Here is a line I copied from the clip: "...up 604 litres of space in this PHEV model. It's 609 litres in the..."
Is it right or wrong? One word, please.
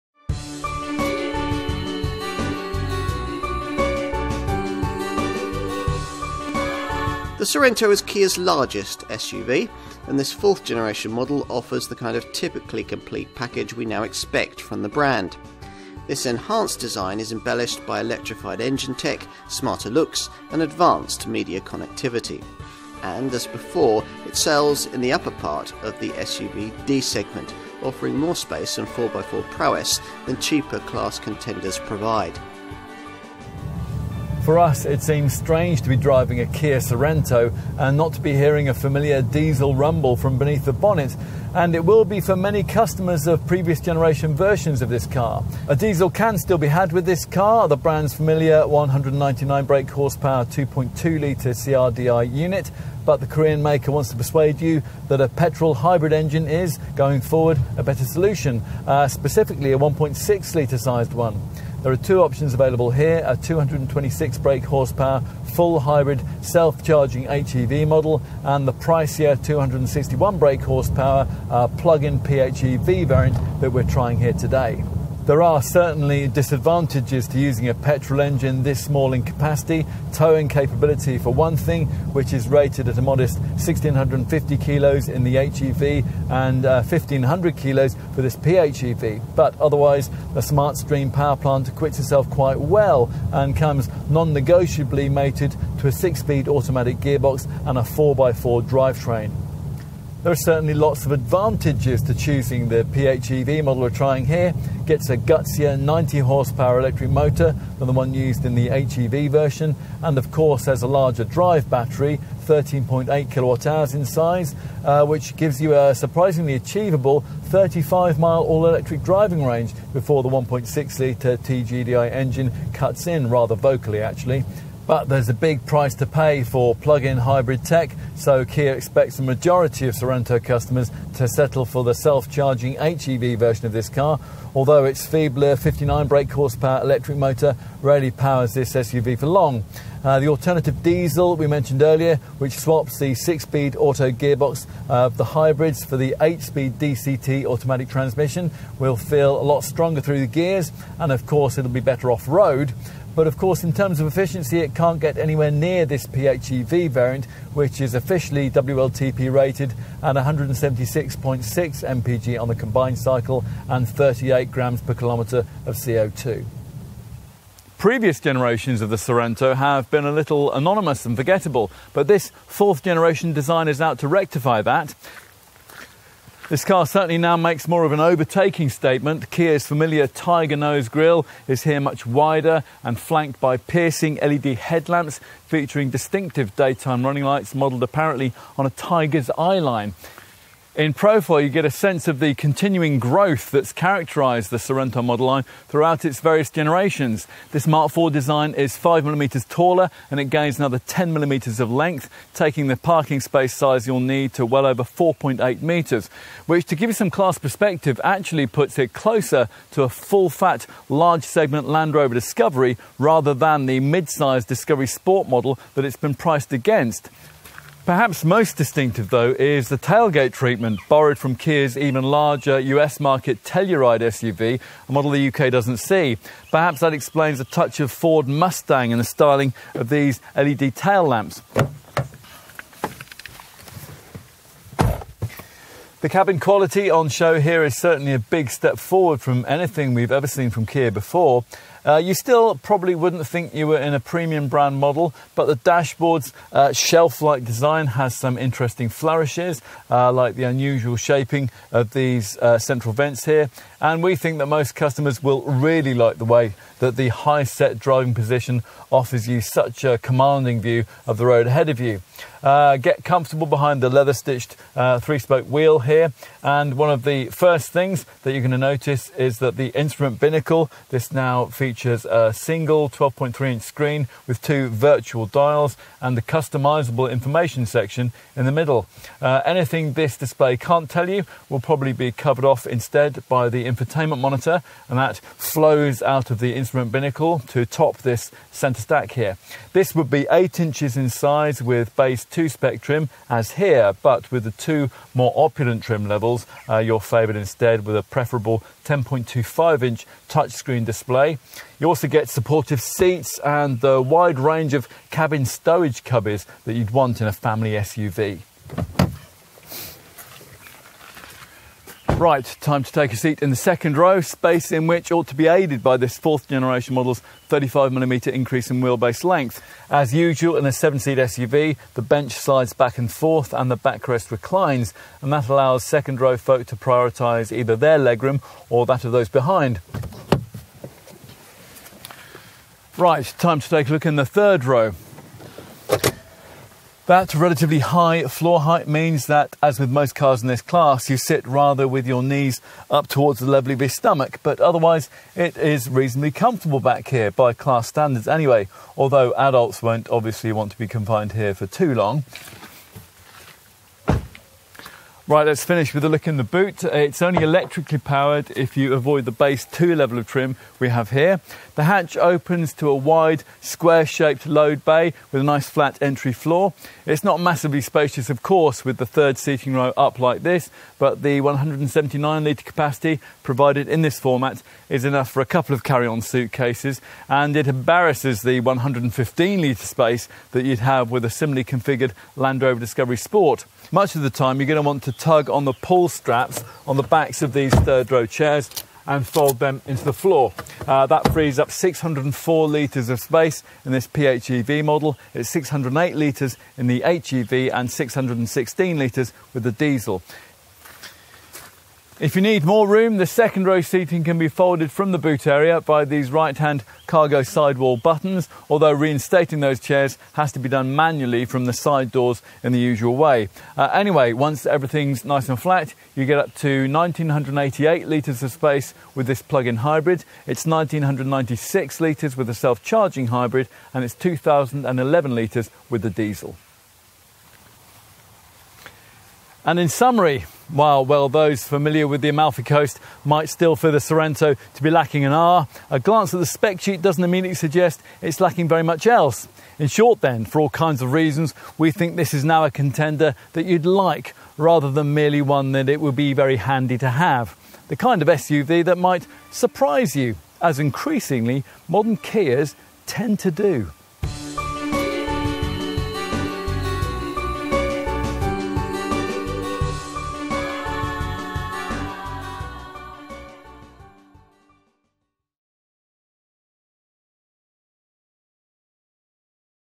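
wrong.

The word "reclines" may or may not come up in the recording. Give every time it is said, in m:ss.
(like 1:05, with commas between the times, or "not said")
5:24.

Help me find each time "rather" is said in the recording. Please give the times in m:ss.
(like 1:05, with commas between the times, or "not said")
2:03, 3:32, 5:41, 7:24.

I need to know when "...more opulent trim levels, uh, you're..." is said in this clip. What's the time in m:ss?
4:55.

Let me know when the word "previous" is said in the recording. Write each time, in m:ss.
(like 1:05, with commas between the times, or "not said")
0:43, 2:47.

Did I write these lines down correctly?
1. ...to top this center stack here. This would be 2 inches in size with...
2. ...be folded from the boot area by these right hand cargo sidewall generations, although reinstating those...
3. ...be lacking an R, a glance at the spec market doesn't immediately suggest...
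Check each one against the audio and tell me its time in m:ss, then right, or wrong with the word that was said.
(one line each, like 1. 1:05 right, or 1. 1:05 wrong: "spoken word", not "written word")
1. 4:47 wrong: "8", not "2"
2. 6:44 wrong: "buttons", not "generations"
3. 7:14 wrong: "sheet", not "market".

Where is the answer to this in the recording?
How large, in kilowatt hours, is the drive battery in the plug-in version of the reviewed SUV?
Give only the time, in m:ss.
1:52.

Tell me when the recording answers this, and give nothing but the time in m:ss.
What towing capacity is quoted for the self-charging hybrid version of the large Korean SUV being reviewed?
1:23.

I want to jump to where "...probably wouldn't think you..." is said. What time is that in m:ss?
4:02.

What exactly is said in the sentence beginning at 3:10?
In profile, you get a sense of the continuing growth that's characterized the Sorento model line throughout its various generations.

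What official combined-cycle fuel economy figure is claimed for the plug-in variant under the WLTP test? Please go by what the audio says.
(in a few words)
176.6 mpg.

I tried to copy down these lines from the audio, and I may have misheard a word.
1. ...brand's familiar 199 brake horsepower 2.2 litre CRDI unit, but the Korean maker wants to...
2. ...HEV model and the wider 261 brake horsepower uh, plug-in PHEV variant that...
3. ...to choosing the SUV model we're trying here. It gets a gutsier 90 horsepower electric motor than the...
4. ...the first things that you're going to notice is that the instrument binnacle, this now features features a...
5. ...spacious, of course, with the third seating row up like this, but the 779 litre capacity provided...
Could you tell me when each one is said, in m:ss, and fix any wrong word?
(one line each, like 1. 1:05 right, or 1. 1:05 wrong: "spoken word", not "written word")
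1. 0:47 right
2. 1:07 wrong: "pricier", not "wider"
3. 1:42 wrong: "PHEV", not "SUV"
4. 4:27 right
5. 6:07 wrong: "179", not "779".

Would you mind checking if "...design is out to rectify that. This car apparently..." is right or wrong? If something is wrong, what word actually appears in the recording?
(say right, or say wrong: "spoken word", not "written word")
wrong: "certainly", not "apparently".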